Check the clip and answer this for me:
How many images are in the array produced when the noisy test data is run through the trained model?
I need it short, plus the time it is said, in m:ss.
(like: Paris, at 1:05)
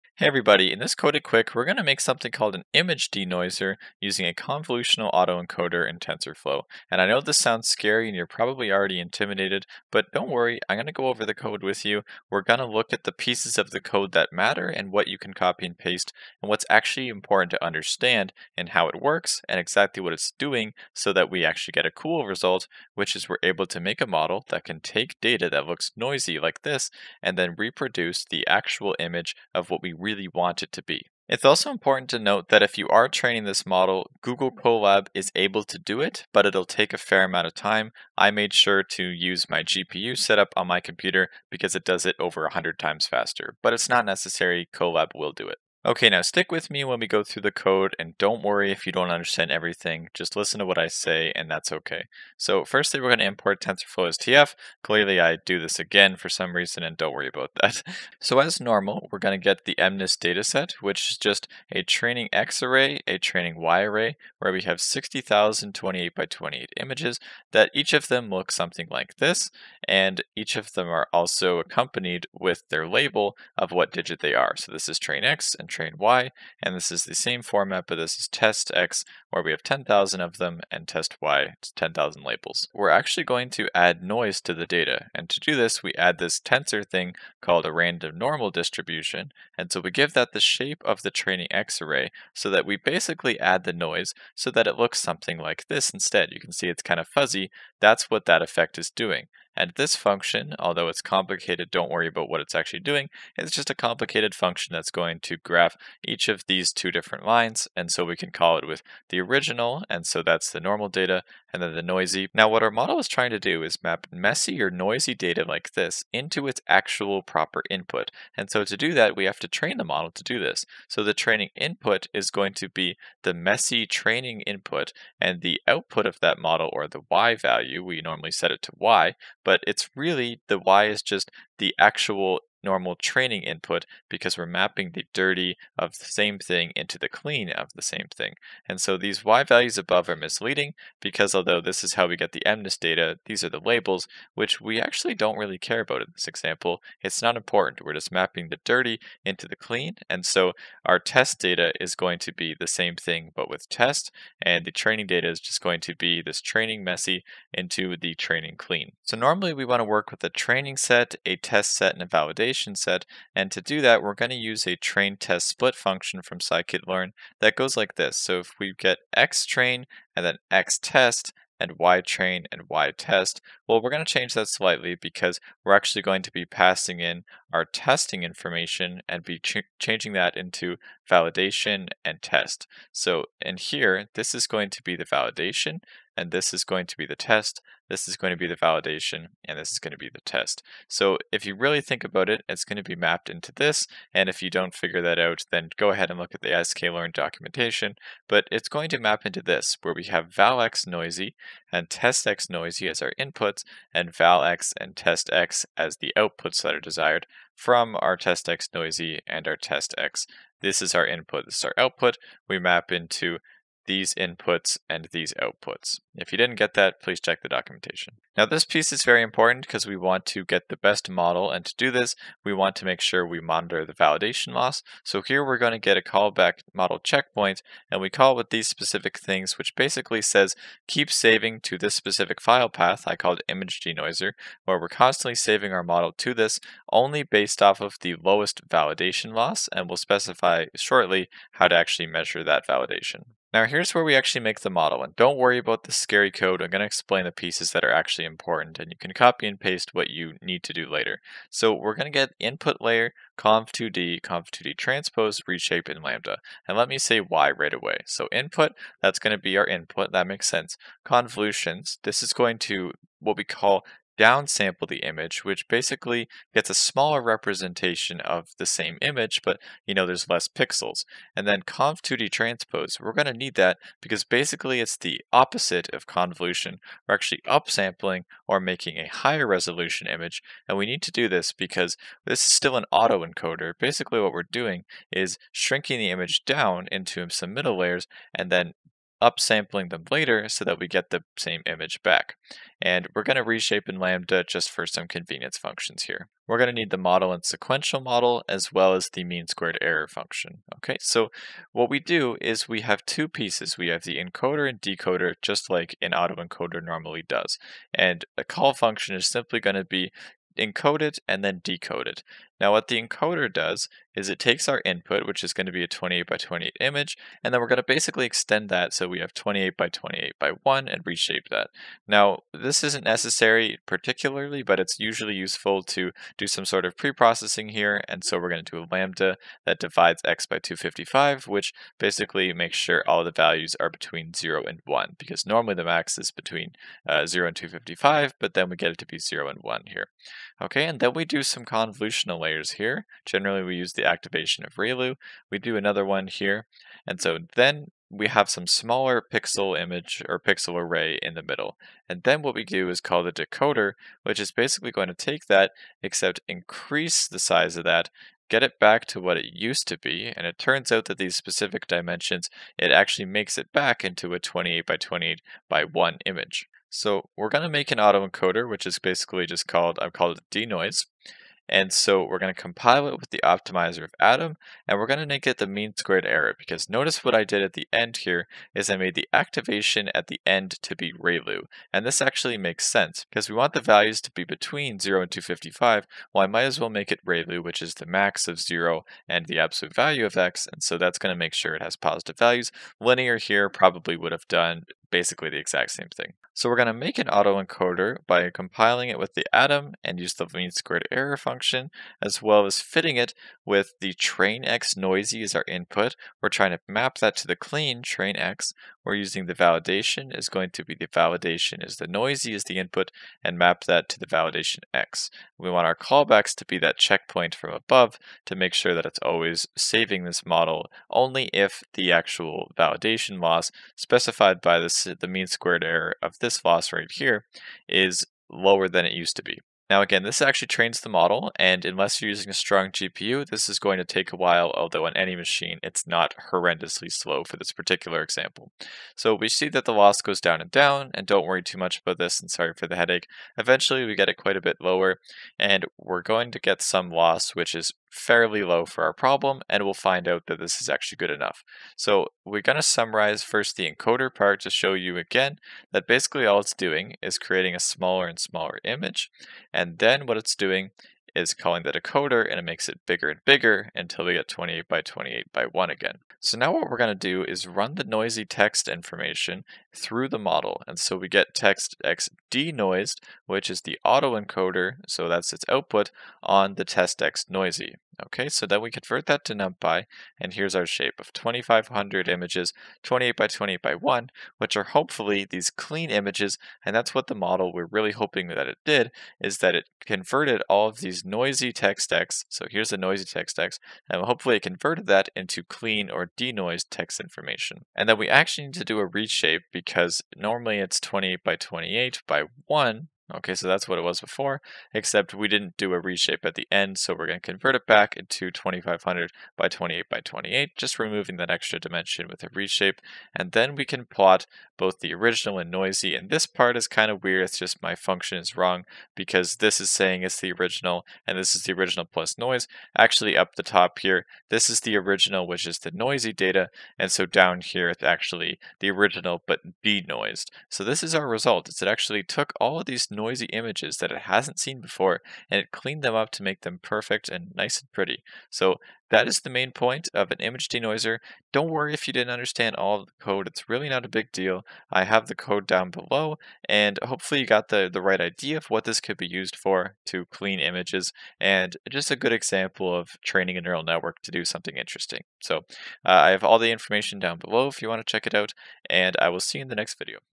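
2,500, at 8:01.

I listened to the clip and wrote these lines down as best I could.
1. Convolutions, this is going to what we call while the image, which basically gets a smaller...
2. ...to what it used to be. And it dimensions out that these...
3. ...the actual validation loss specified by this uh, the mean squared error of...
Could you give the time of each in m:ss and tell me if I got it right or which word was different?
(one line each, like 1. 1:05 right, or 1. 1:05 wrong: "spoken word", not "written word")
1. 4:21 wrong: "downsample", not "while"
2. 5:59 wrong: "turns", not "dimensions"
3. 7:01 right.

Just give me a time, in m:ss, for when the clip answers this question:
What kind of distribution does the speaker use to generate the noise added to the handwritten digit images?
1:27.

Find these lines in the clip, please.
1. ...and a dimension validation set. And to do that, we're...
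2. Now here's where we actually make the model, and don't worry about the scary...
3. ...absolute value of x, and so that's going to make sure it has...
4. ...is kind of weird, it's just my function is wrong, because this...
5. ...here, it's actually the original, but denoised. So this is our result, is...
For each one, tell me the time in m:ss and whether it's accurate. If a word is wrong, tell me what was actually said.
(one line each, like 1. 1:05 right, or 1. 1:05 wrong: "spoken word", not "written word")
1. 2:41 wrong: "validation", not "dimension"
2. 4:03 right
3. 6:29 right
4. 8:36 right
5. 8:47 right.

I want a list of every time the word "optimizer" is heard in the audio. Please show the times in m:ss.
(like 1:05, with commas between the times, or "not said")
6:13.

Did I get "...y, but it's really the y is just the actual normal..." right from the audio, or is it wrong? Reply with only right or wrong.
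right.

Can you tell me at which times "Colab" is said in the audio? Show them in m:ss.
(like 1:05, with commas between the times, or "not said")
0:34, 0:44.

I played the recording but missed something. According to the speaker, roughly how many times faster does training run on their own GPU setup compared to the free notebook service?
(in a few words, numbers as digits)
over 100 times.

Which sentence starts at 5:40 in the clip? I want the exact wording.
Okay, and then we do some convolutional layers here.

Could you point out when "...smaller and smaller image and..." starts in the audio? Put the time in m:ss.
7:37.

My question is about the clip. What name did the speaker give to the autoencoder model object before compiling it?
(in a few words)
denoise.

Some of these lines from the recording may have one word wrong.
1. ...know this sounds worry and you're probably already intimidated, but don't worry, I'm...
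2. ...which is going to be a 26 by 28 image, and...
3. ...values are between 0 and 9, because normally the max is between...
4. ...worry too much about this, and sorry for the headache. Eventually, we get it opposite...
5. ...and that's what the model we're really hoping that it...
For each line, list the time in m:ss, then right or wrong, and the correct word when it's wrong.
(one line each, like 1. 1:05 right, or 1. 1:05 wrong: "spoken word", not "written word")
1. 0:07 wrong: "scary", not "worry"
2. 5:15 wrong: "28", not "26"
3. 5:33 wrong: "1", not "9"
4. 7:21 wrong: "quite", not "opposite"
5. 8:06 right.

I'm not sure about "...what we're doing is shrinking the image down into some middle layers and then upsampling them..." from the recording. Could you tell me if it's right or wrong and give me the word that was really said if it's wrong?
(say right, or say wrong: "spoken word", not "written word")
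right.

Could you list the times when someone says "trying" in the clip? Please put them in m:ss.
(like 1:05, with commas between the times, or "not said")
1:53, 6:46.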